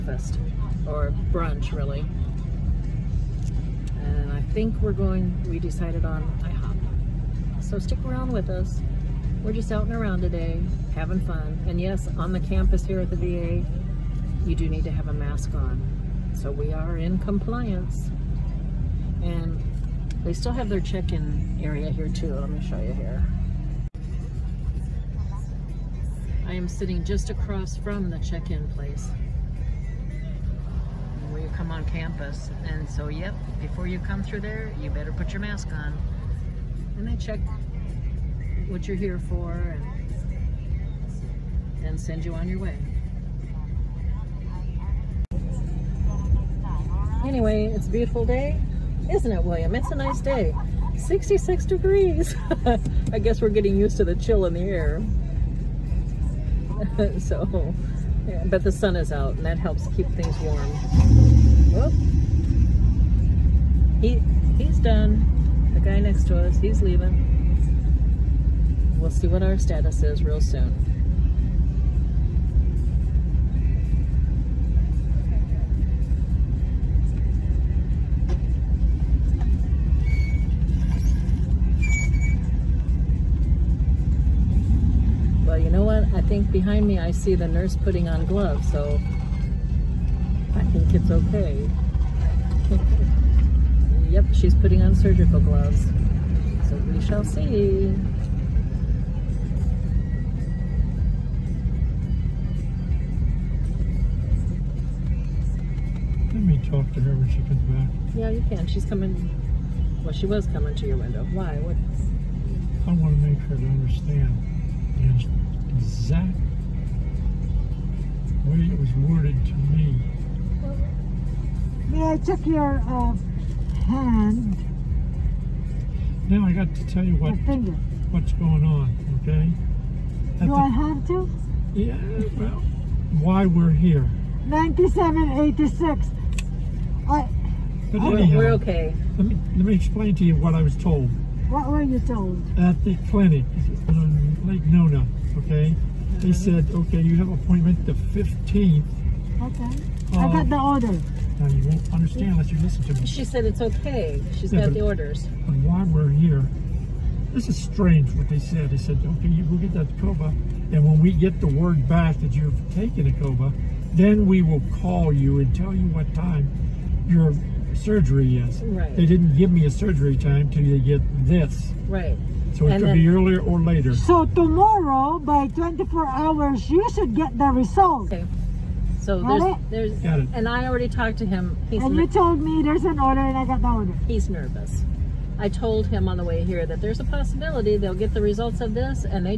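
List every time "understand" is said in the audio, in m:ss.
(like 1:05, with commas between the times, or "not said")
1:53, 2:31.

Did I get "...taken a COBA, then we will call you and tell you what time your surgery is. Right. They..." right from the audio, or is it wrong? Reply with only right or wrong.
right.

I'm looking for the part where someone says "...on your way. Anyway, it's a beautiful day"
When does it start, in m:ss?
0:42.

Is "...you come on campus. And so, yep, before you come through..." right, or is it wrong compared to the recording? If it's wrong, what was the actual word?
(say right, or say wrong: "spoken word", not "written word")
right.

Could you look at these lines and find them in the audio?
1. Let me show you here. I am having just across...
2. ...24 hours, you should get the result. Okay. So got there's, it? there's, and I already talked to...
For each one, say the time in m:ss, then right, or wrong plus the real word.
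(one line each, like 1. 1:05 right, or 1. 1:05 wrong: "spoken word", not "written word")
1. 0:22 wrong: "sitting", not "having"
2. 2:55 right.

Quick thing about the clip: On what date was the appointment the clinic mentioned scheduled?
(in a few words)
the 15th.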